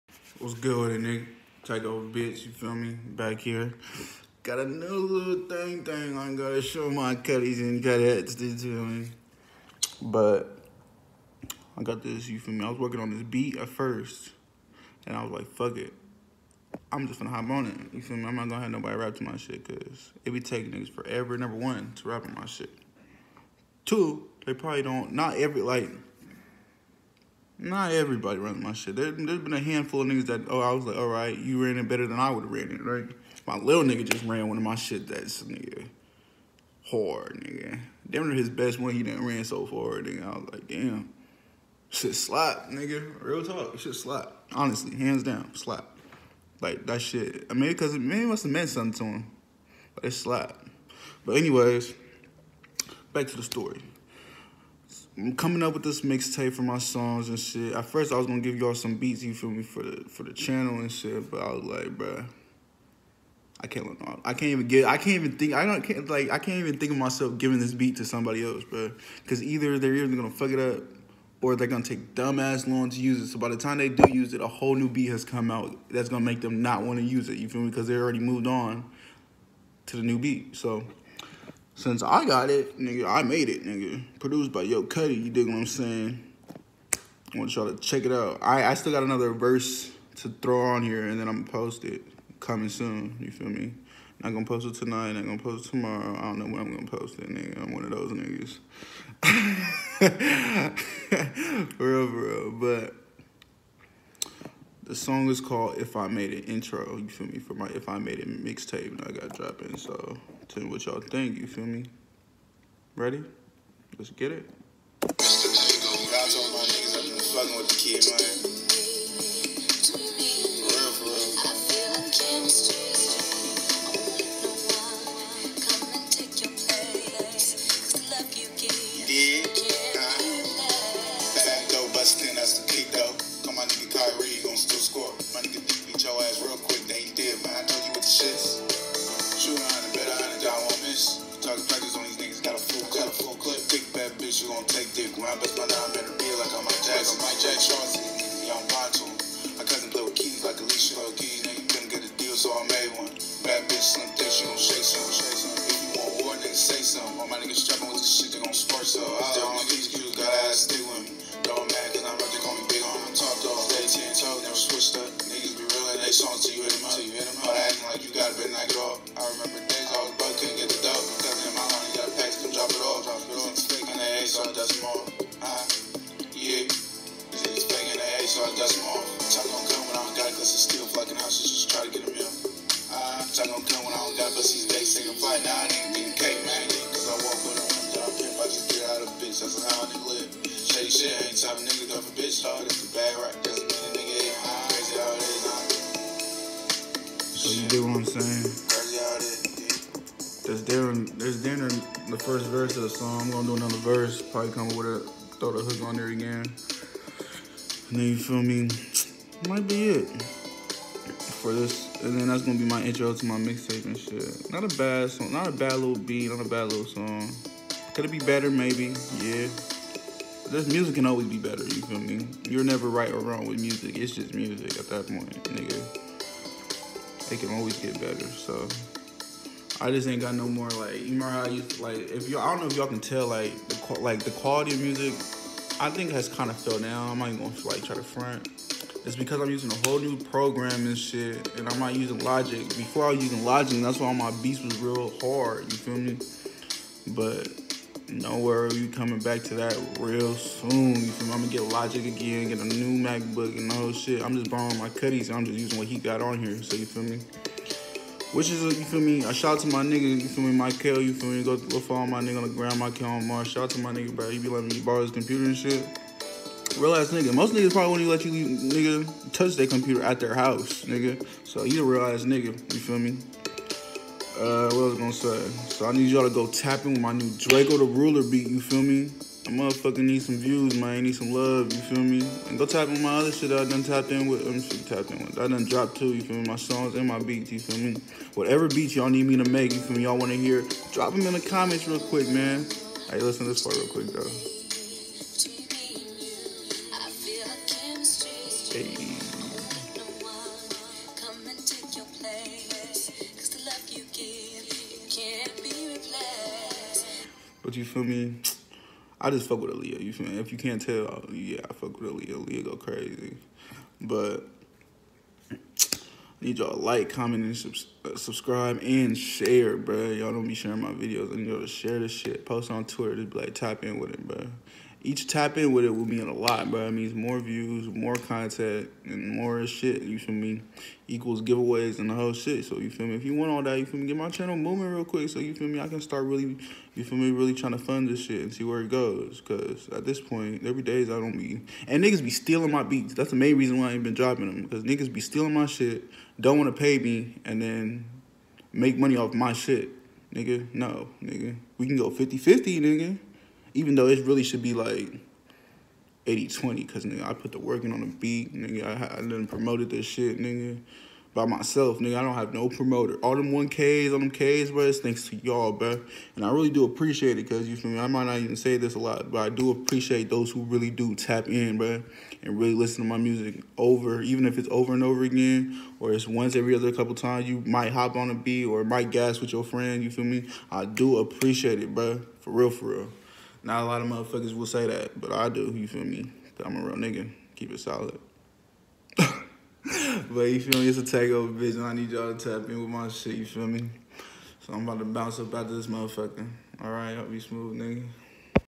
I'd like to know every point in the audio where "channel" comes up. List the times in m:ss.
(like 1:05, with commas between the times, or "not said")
1:00, 5:34.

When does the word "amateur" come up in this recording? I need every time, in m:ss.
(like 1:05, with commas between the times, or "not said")
not said.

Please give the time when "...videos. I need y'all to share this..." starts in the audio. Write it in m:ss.
5:20.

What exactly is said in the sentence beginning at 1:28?
I, I still got another verse to throw on here, and then I'm gonna post it.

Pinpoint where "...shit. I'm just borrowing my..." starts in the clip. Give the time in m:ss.
4:13.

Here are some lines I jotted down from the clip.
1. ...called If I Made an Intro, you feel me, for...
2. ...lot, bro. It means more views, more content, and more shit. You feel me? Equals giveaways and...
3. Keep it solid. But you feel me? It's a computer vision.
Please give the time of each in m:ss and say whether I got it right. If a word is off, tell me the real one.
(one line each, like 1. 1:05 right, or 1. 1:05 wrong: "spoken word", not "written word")
1. 1:45 right
2. 5:26 right
3. 6:27 wrong: "takeover", not "computer".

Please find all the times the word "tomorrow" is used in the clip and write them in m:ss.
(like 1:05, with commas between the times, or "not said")
1:35.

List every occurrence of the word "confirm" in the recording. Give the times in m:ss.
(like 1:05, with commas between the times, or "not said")
not said.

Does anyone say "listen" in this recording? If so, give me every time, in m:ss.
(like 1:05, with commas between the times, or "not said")
4:53, 6:12.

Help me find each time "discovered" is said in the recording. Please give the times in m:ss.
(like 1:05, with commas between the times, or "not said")
not said.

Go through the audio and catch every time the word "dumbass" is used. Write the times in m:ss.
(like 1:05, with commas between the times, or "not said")
1:12.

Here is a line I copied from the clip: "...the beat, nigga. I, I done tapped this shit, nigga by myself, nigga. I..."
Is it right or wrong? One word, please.
wrong.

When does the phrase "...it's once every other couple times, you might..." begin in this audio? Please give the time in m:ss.
6:16.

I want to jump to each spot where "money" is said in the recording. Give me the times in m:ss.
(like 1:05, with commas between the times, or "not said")
5:48.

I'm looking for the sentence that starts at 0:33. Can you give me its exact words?
My little nigga just ran one of my shit that's, nigga, hard, nigga.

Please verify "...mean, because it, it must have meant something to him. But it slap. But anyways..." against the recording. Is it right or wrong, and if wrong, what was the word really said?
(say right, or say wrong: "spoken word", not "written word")
right.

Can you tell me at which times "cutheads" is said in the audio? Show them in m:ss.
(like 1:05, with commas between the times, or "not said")
0:07.